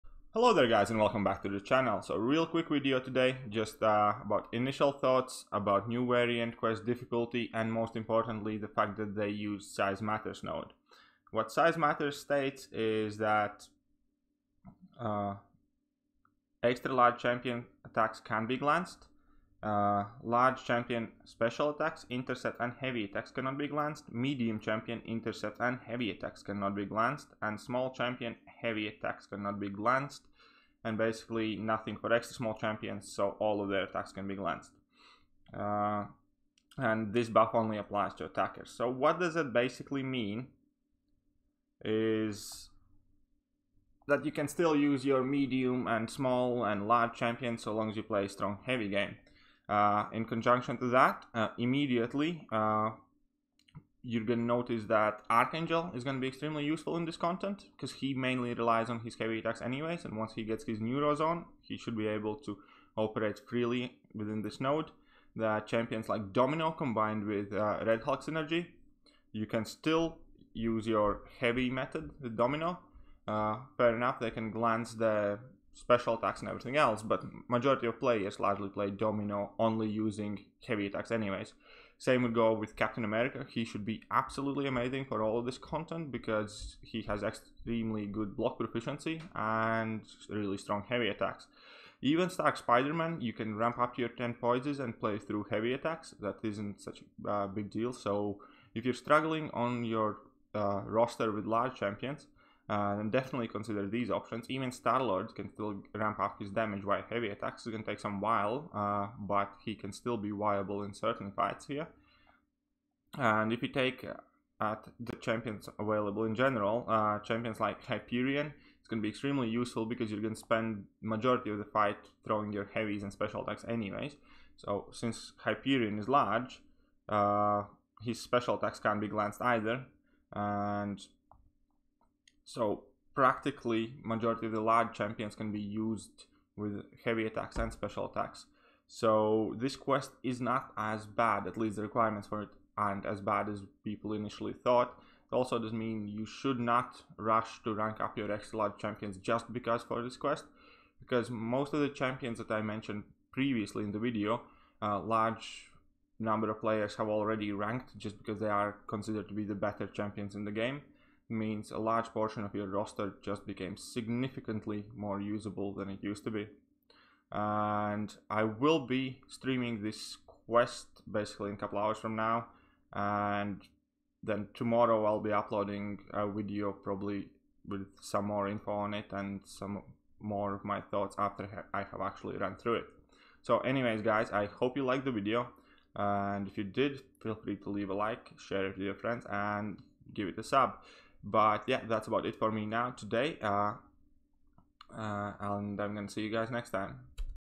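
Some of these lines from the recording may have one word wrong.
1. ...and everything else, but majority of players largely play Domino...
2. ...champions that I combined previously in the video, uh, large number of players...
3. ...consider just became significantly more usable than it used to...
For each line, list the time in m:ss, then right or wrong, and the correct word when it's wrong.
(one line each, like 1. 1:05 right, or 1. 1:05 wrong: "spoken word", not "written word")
1. 1:16 right
2. 2:31 wrong: "mentioned", not "combined"
3. 2:42 wrong: "roster", not "consider".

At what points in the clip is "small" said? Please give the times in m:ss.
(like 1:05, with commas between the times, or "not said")
0:27, 0:32, 0:46.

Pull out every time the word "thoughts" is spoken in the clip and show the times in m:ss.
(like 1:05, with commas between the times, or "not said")
0:04, 2:24, 3:00.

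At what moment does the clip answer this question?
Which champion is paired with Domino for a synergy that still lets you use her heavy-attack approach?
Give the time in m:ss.
1:07.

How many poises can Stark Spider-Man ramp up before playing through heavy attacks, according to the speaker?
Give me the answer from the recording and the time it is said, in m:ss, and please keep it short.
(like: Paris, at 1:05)
10, at 1:34.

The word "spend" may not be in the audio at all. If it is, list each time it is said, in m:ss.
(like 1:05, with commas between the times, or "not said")
2:00.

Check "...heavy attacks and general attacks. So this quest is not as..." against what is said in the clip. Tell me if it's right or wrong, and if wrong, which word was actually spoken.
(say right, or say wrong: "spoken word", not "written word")
wrong: "special", not "general".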